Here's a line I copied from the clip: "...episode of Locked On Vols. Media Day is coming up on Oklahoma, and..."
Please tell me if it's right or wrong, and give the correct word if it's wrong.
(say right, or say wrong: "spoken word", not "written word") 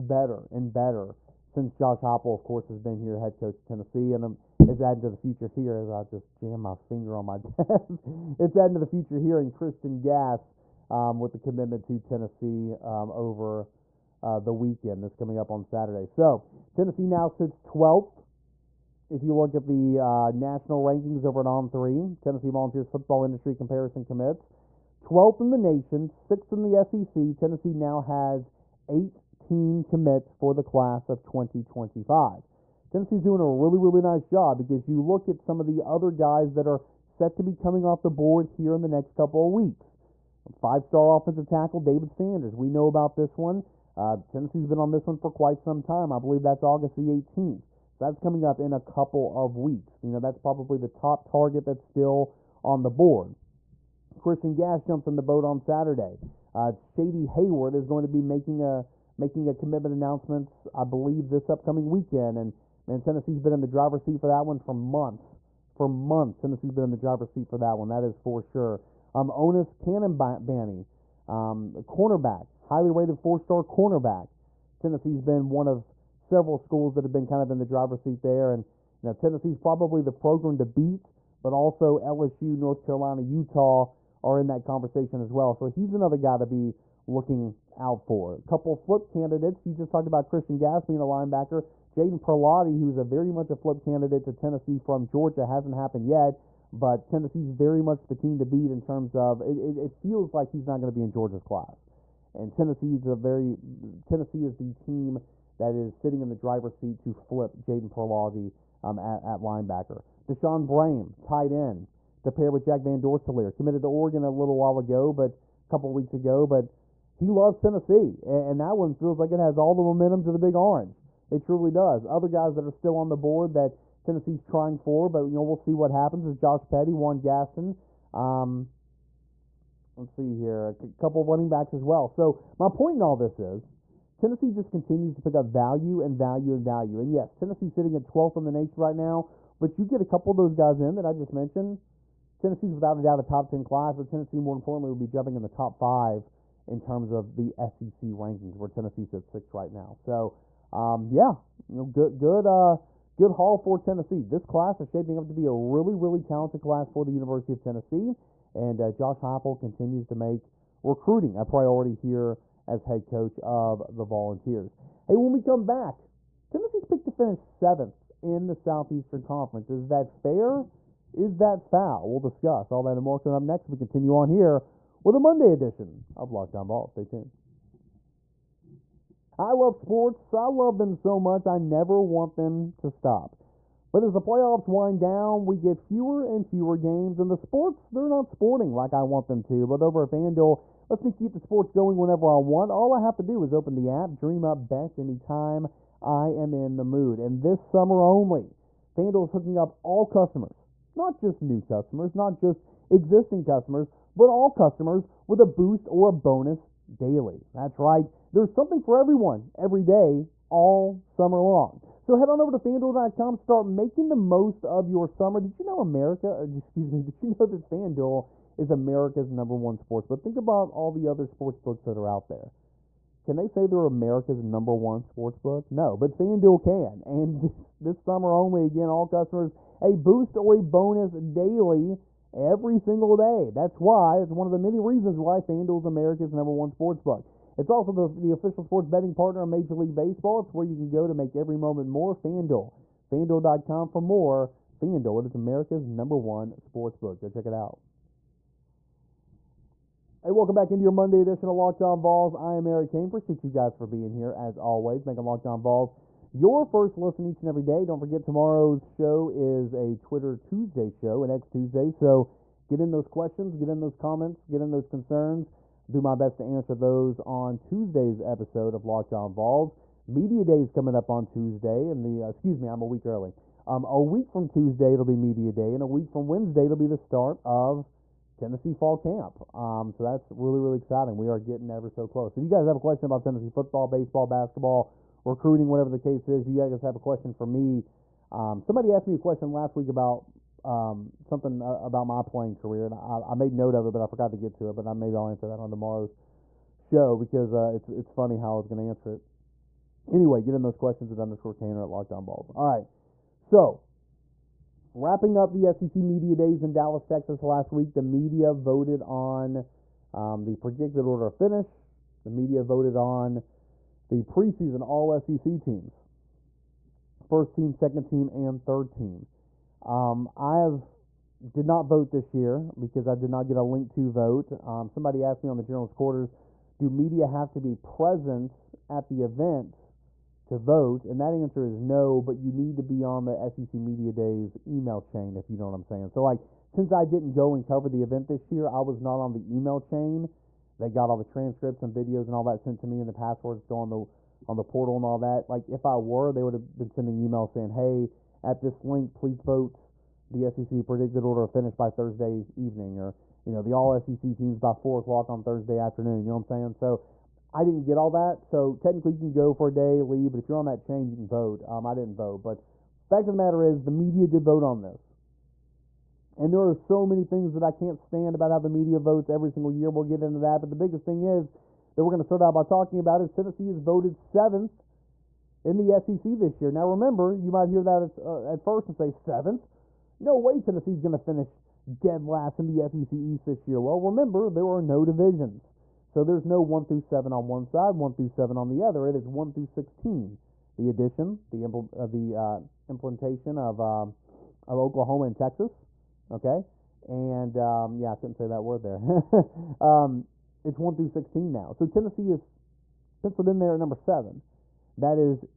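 wrong: "Tuesday", not "Oklahoma".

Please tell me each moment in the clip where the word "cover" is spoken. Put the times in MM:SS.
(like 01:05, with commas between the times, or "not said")
05:37.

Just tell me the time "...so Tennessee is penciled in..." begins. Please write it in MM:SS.
06:41.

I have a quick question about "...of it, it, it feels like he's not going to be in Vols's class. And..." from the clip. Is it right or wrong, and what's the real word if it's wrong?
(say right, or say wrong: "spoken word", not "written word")
wrong: "Georgia", not "Vols".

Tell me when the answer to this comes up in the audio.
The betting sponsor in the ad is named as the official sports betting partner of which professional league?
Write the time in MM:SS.
03:59.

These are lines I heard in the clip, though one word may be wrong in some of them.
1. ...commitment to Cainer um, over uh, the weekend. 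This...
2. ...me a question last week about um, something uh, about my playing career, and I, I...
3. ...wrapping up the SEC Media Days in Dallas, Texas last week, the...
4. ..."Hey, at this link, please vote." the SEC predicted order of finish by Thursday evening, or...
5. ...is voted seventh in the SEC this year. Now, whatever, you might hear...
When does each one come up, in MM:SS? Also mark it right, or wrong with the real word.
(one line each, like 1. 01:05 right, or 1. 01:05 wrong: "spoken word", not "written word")
1. 00:11 wrong: "Tennessee", not "Cainer"
2. 04:49 right
3. 05:04 right
4. 05:47 right
5. 06:13 wrong: "remember", not "whatever".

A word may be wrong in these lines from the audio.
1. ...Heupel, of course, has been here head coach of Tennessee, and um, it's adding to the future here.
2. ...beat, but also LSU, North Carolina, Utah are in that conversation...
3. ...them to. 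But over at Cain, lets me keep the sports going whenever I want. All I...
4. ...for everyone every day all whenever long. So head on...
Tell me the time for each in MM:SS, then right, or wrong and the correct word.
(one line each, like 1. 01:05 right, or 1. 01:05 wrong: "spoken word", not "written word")
1. 00:02 right
2. 01:20 right
3. 03:09 wrong: "FanDuel", not "Cain"
4. 03:28 wrong: "summer", not "whenever".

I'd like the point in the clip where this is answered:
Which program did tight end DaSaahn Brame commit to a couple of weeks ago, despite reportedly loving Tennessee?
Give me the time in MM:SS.
01:53.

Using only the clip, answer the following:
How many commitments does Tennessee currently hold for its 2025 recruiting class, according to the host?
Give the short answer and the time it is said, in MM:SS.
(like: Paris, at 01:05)
18, at 00:28.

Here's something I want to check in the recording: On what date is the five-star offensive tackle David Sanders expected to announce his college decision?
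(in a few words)
August 18.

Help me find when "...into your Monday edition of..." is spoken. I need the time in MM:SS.
04:10.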